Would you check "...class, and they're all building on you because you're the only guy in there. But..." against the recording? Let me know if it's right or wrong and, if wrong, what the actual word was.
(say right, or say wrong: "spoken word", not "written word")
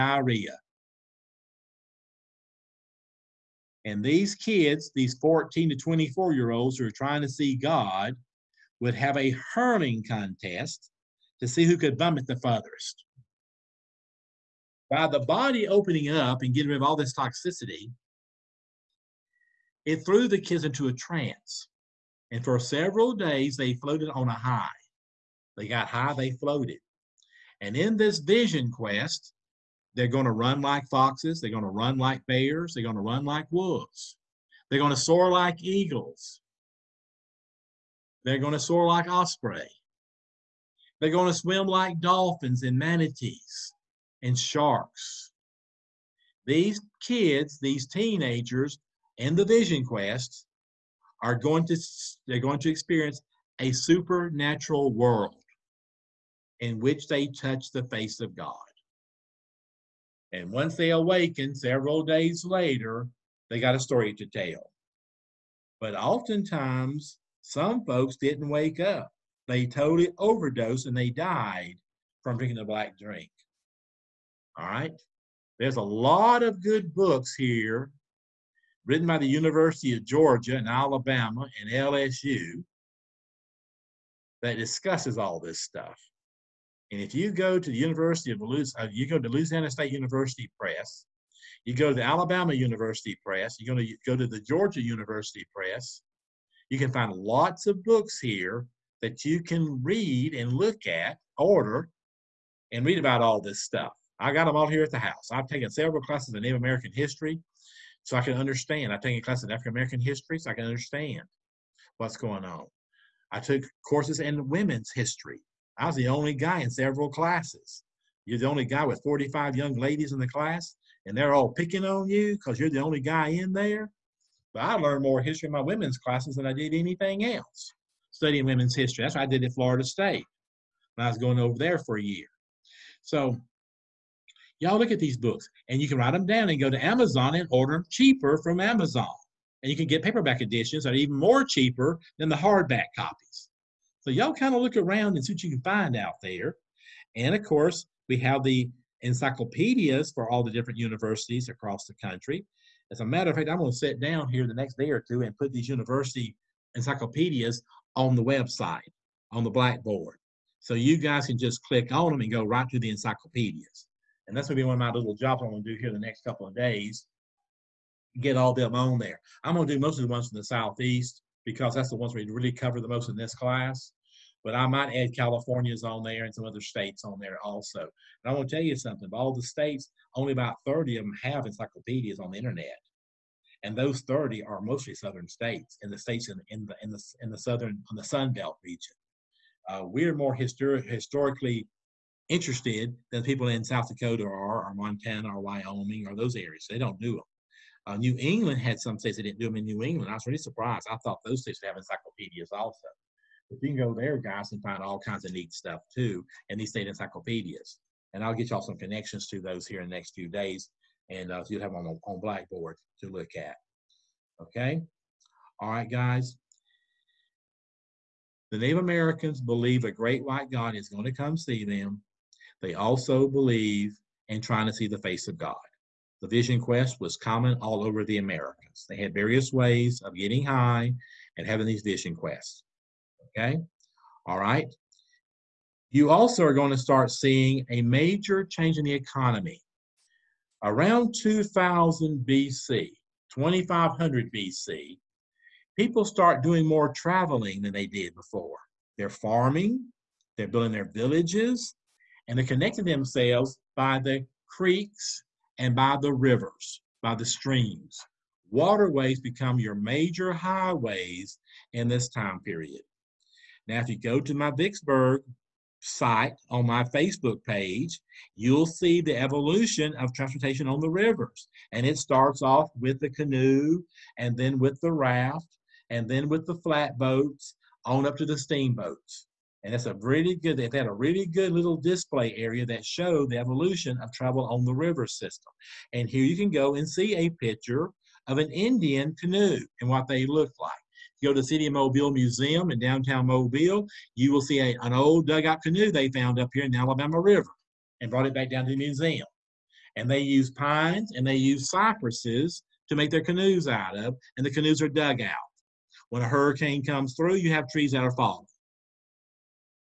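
wrong: "picking", not "building".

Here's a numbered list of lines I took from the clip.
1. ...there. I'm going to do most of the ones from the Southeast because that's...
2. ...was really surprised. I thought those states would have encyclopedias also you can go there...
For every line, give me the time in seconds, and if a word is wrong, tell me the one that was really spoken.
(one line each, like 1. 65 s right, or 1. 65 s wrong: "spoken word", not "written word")
1. 168 s right
2. 200 s right.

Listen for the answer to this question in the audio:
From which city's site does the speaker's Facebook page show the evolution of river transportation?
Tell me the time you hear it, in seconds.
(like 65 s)
264 s.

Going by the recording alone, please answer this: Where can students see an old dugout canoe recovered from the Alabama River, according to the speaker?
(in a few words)
City of Mobile Museum.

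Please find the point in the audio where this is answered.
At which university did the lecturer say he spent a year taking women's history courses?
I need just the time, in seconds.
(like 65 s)
129 s.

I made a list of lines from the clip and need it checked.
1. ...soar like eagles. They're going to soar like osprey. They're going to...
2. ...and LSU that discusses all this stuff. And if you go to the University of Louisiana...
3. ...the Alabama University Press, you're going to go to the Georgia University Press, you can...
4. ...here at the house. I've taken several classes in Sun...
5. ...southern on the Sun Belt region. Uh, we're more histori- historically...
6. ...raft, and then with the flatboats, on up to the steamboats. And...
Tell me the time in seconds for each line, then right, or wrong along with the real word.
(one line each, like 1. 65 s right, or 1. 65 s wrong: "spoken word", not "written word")
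1. 34 s right
2. 81 s right
3. 91 s right
4. 104 s wrong: "Native", not "Sun"
5. 187 s right
6. 274 s right.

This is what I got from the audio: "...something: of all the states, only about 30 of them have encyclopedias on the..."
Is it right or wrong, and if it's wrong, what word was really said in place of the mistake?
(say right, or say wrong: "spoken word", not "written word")
right.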